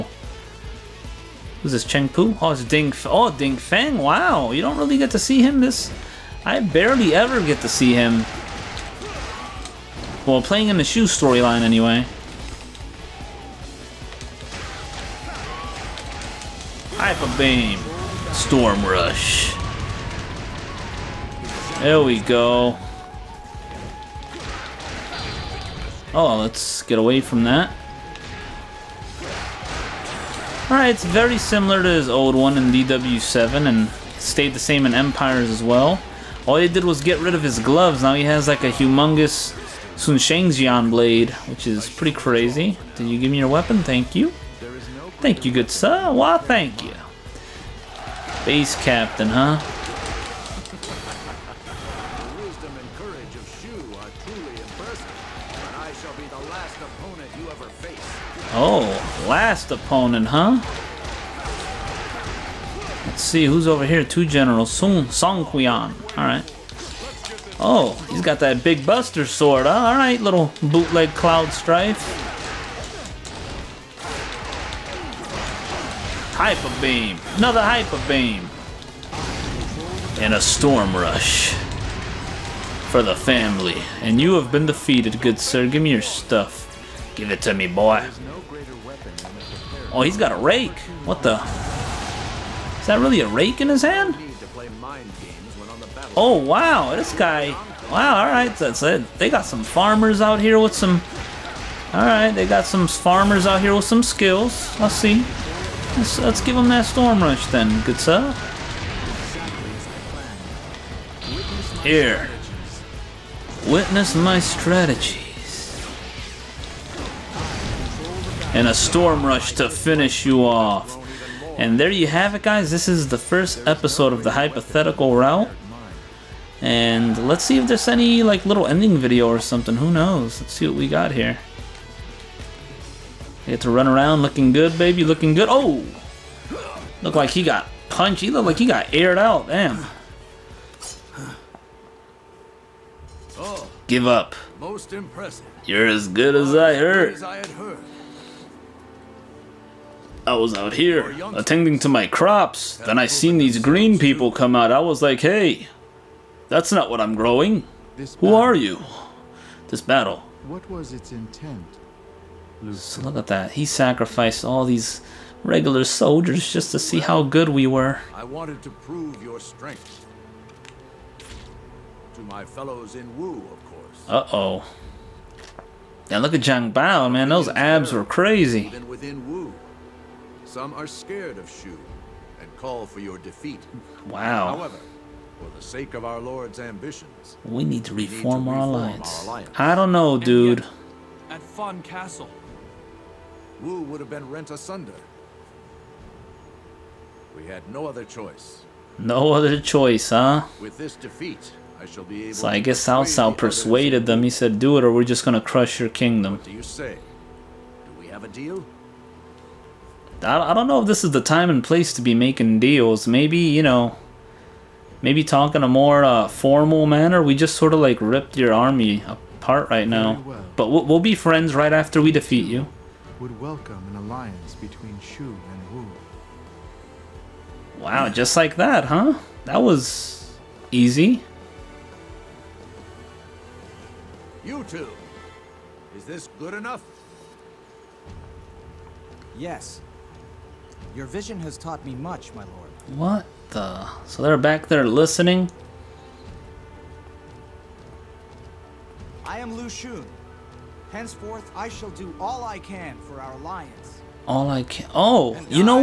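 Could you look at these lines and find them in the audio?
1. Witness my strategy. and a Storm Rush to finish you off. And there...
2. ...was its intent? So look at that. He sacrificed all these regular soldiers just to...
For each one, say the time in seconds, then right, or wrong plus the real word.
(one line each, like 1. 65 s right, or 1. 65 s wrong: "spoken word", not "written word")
1. 113 s right
2. 160 s right.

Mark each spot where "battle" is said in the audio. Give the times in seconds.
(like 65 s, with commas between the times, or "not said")
159 s.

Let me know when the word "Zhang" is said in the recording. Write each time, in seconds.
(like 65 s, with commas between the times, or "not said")
176 s.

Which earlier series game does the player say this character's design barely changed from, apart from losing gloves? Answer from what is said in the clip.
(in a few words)
DW7.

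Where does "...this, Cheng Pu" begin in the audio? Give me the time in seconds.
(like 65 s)
1 s.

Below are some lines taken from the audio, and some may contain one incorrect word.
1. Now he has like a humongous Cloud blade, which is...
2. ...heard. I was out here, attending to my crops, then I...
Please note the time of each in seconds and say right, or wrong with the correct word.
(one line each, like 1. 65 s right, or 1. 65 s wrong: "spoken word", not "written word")
1. 38 s wrong: "Sunshengjian", not "Cloud"
2. 146 s right.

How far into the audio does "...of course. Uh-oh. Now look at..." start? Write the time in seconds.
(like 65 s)
173 s.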